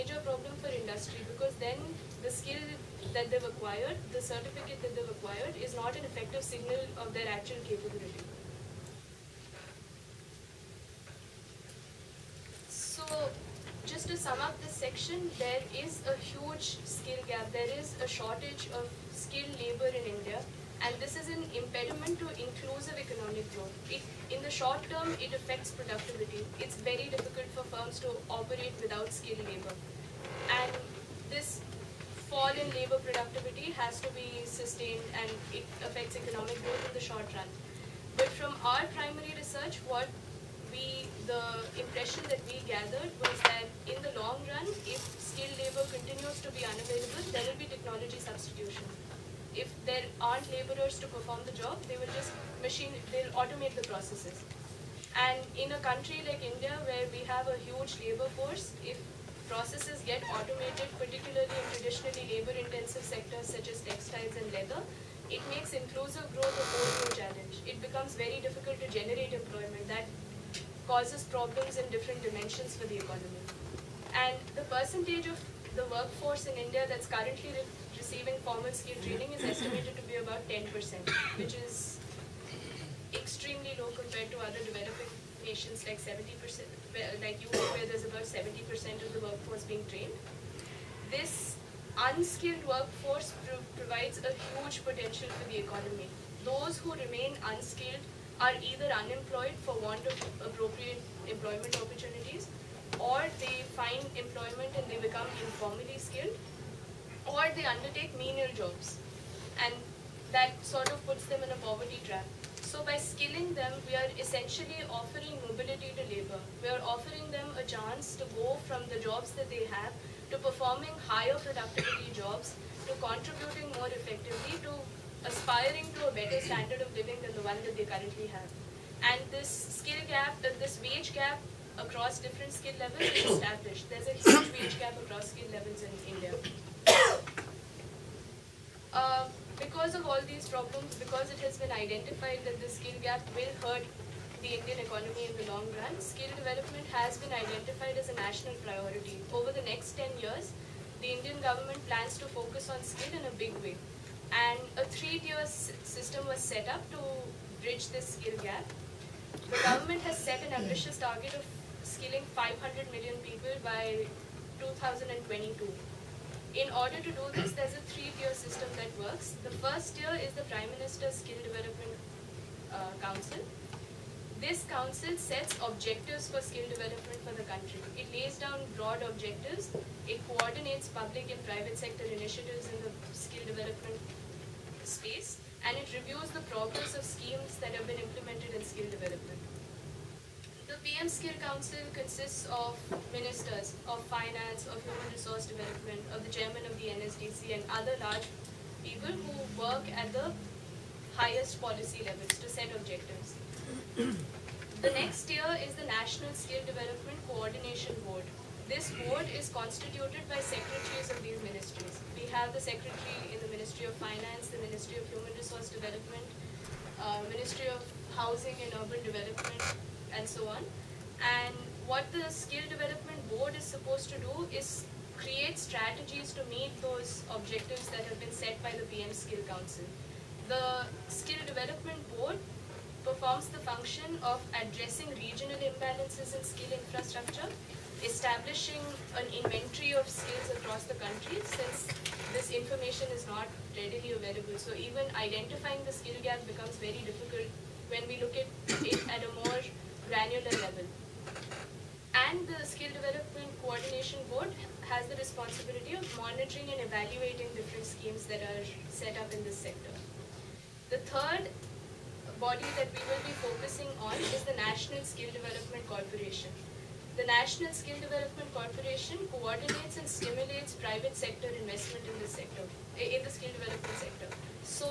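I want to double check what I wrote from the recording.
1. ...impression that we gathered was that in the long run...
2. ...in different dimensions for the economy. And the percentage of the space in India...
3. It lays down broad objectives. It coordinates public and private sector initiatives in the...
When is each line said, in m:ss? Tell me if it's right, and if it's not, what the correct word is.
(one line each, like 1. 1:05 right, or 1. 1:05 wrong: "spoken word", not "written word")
1. 0:41 right
2. 1:11 wrong: "workforce", not "space"
3. 2:57 right.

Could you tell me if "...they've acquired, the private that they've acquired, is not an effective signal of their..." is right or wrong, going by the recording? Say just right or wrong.
wrong.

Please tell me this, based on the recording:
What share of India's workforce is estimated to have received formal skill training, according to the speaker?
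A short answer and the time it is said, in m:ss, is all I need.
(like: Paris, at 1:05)
10%, at 1:20.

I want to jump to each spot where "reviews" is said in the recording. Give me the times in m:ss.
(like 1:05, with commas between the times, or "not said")
3:05.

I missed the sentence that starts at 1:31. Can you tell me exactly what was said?
This unskilled workforce pro provides a huge potential for the economy.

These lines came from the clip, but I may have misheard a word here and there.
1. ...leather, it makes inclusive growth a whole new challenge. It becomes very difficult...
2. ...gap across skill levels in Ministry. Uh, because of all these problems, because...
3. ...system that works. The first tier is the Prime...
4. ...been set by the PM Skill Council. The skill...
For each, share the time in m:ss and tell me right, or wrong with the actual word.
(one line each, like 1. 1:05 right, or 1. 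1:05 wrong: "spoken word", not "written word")
1. 1:04 right
2. 2:14 wrong: "India", not "Ministry"
3. 2:48 right
4. 3:48 right.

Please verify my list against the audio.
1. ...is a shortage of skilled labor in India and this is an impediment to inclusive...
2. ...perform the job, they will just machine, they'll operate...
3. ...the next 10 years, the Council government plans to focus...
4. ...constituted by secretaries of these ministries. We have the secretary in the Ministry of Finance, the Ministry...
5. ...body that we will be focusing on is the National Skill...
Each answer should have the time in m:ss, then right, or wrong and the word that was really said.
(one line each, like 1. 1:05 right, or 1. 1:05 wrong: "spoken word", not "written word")
1. 0:17 right
2. 0:51 wrong: "automate", not "operate"
3. 2:29 wrong: "Indian", not "Council"
4. 3:29 right
5. 4:22 right.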